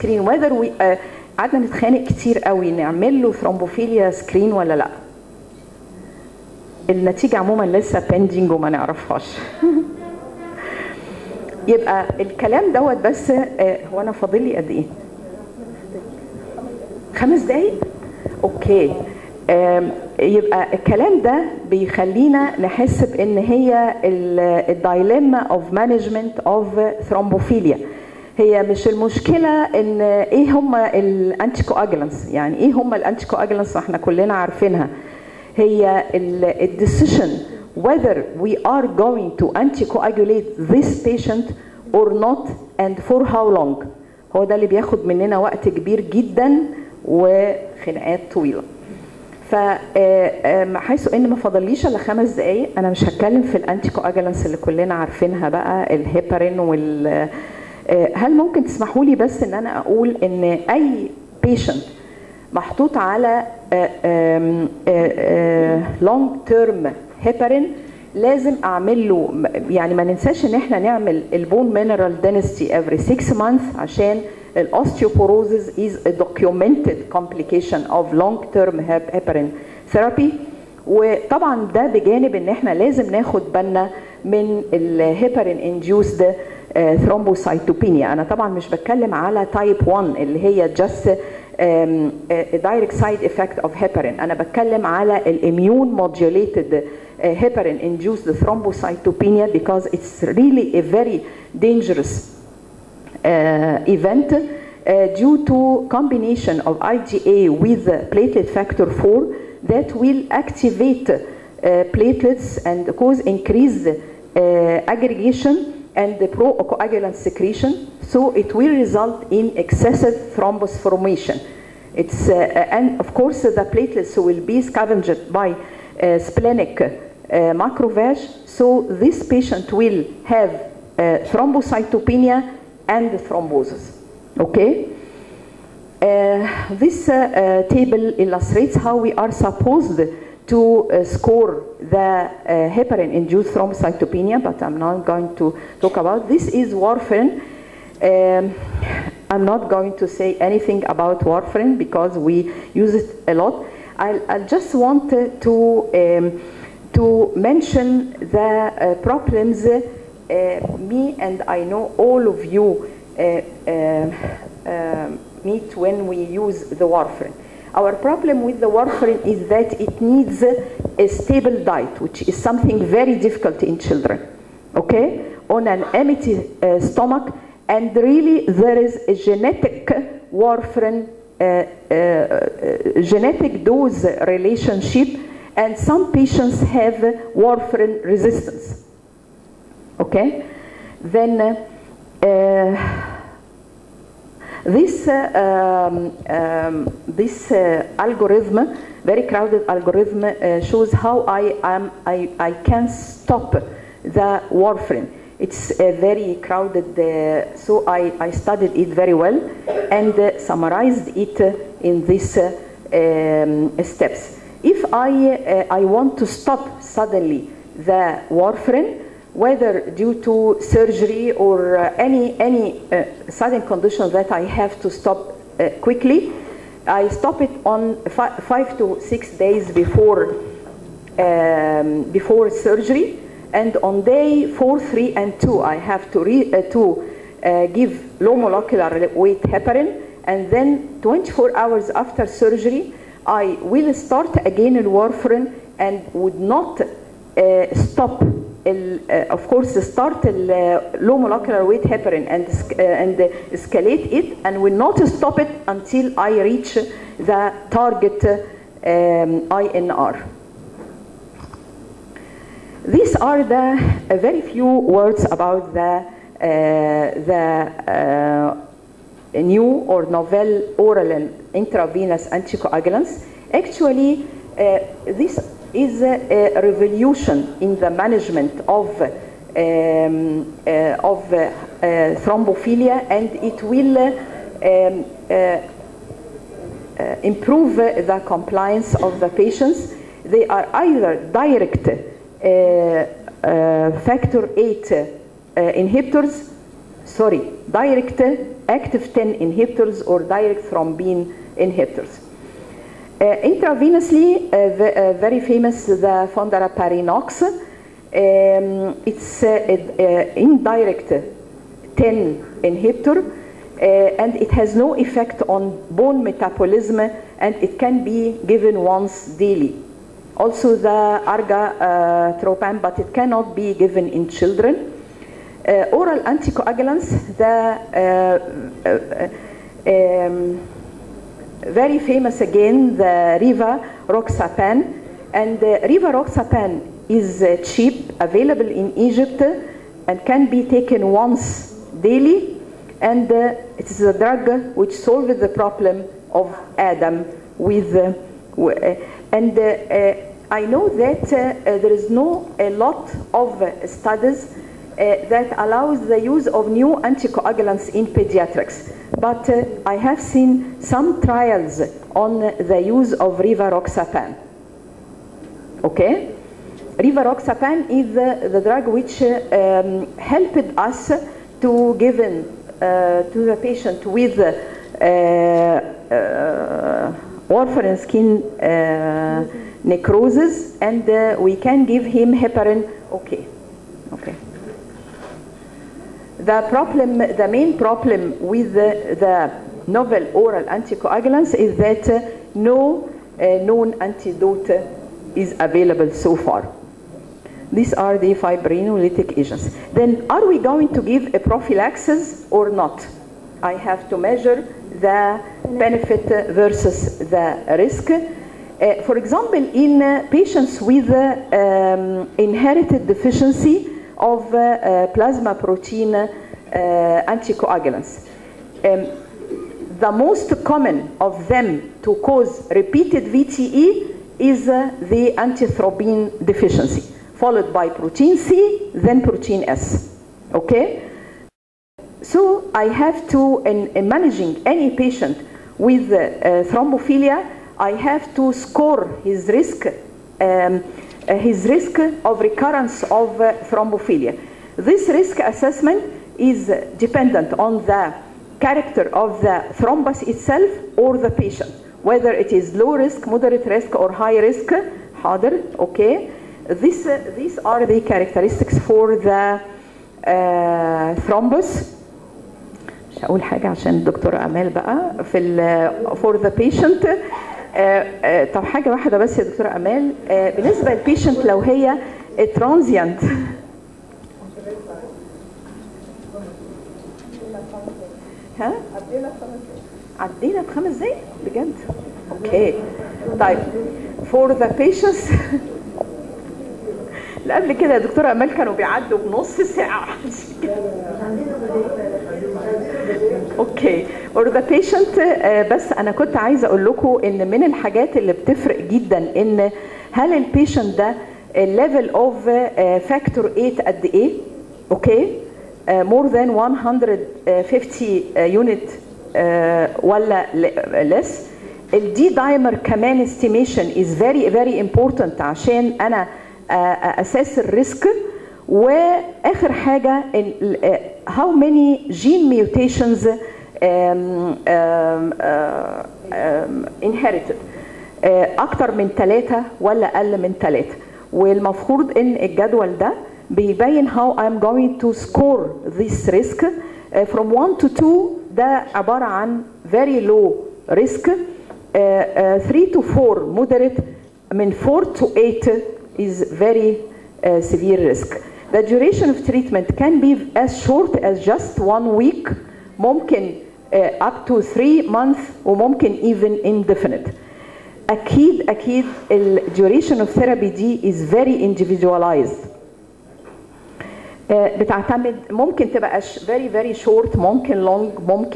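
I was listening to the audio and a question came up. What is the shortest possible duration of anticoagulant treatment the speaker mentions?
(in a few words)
One week.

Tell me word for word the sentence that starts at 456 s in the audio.
This, uh, these are the characteristics for the uh, thrombus.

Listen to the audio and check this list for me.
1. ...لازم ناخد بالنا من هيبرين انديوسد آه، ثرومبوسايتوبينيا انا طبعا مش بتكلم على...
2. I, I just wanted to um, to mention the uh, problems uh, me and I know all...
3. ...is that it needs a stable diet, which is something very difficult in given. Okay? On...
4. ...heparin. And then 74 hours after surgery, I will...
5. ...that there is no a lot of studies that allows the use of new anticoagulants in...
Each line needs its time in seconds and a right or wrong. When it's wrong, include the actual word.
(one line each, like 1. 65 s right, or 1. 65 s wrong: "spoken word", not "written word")
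1. 82 s wrong: "الهيبرين", not "هيبرين"
2. 153 s right
3. 169 s wrong: "children", not "given"
4. 239 s wrong: "24", not "74"
5. 350 s right.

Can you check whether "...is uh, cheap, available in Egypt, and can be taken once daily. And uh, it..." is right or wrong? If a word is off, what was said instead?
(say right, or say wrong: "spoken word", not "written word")
right.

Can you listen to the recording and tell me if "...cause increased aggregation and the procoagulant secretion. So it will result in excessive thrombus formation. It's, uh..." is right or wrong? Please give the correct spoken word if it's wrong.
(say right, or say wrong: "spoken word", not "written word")
right.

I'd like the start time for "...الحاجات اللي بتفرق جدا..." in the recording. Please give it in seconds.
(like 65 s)
497 s.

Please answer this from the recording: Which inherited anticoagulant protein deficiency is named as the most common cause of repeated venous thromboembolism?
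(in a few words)
Antithrombin deficiency.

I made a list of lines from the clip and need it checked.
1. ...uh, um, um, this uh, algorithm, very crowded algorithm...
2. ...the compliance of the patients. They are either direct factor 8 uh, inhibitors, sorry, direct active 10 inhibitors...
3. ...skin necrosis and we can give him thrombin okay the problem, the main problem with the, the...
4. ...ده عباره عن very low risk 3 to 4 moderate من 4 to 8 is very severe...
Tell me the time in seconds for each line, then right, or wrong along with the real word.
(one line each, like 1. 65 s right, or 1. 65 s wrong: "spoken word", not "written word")
1. 195 s right
2. 287 s right
3. 377 s wrong: "heparin", not "thrombin"
4. 538 s right.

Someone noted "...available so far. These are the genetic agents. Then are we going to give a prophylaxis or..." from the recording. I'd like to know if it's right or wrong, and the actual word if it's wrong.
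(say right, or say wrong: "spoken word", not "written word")
wrong: "fibrinolytic", not "genetic".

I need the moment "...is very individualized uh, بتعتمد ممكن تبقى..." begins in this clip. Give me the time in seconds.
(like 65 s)
561 s.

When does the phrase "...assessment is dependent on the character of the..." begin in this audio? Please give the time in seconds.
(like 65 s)
445 s.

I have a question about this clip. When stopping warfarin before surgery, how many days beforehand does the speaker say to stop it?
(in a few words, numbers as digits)
5 to 6 days.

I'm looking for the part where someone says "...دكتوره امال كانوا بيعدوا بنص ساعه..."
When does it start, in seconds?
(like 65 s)
487 s.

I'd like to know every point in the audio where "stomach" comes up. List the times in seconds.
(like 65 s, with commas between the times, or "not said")
176 s.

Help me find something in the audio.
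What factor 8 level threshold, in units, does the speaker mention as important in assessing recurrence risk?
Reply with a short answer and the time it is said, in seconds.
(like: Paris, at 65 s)
150 units, at 506 s.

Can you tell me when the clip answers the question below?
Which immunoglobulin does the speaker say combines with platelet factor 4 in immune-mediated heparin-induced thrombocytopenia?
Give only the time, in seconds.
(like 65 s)
106 s.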